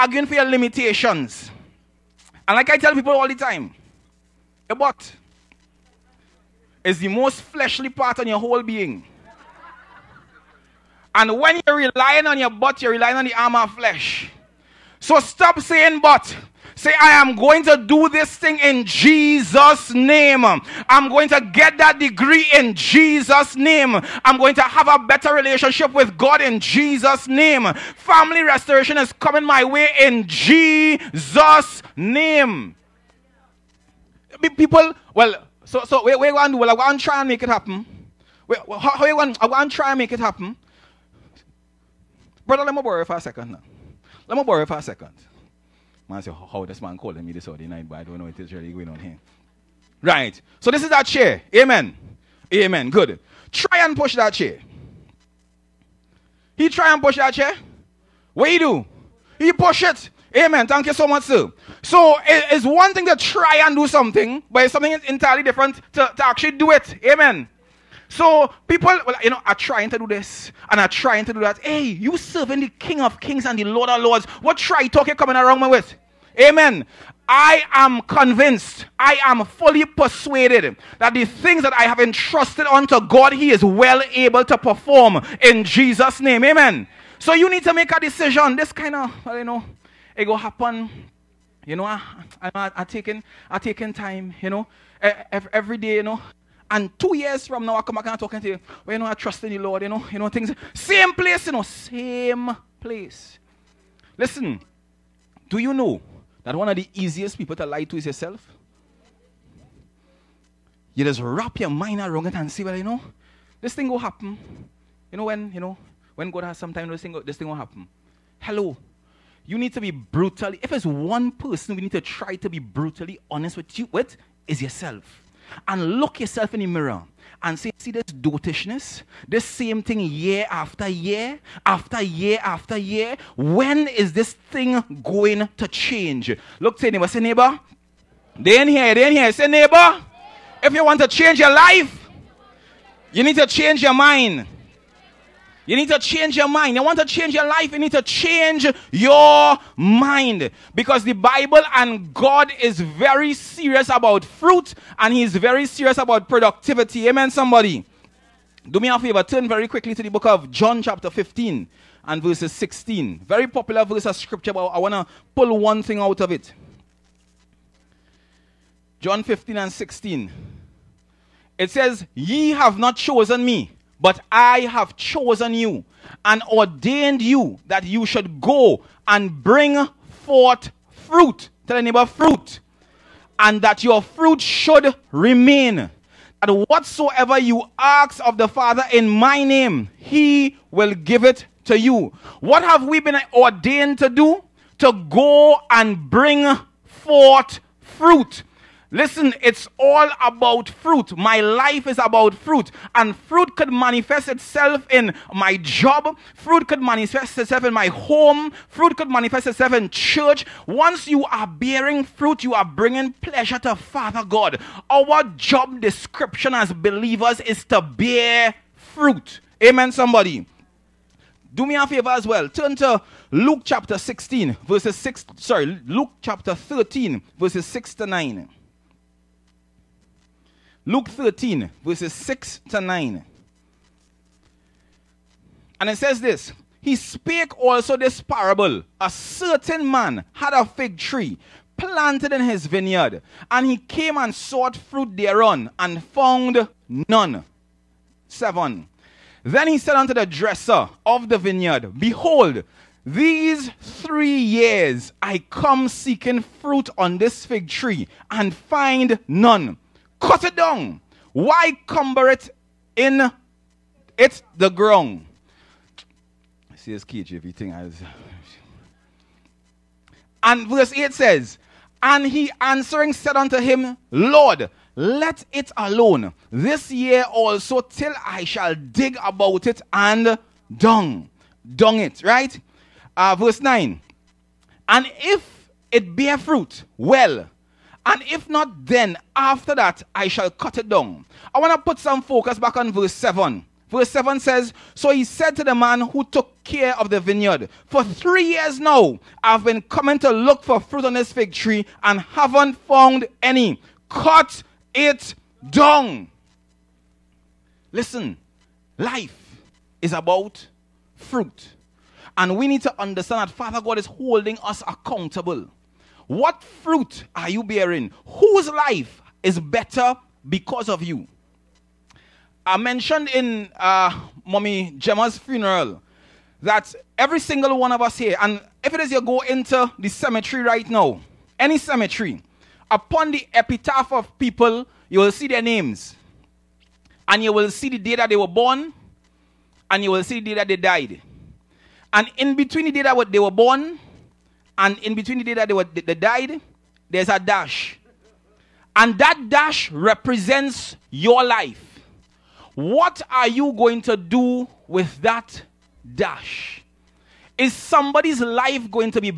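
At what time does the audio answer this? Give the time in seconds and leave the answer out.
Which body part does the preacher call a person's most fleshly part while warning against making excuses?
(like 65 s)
12 s.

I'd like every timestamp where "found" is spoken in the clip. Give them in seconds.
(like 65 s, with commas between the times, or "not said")
246 s, 302 s.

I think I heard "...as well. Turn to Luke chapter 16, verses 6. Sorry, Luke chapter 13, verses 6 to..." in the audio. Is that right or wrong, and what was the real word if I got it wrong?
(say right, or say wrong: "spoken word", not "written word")
right.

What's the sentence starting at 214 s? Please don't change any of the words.
Our job description as believers is to bear fruit.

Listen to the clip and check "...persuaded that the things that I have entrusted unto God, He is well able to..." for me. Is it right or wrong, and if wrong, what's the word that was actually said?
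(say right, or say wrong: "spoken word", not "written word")
right.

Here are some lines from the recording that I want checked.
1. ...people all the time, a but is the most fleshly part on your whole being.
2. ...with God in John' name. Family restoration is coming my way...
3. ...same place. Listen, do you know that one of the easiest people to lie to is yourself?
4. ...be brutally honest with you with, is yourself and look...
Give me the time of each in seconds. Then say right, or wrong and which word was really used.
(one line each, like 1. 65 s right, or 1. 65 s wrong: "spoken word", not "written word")
1. 2 s right
2. 25 s wrong: "Jesus", not "John"
3. 101 s right
4. 122 s right.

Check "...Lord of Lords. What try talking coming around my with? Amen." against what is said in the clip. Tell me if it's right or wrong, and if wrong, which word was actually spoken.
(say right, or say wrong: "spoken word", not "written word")
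right.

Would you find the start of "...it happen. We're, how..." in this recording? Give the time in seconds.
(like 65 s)
37 s.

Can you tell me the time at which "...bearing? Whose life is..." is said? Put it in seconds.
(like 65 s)
317 s.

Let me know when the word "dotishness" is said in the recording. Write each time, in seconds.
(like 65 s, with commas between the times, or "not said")
128 s.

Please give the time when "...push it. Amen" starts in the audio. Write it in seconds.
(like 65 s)
59 s.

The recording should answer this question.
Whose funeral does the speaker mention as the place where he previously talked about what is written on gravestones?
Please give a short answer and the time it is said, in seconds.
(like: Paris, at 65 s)
Mommy Gemma, at 324 s.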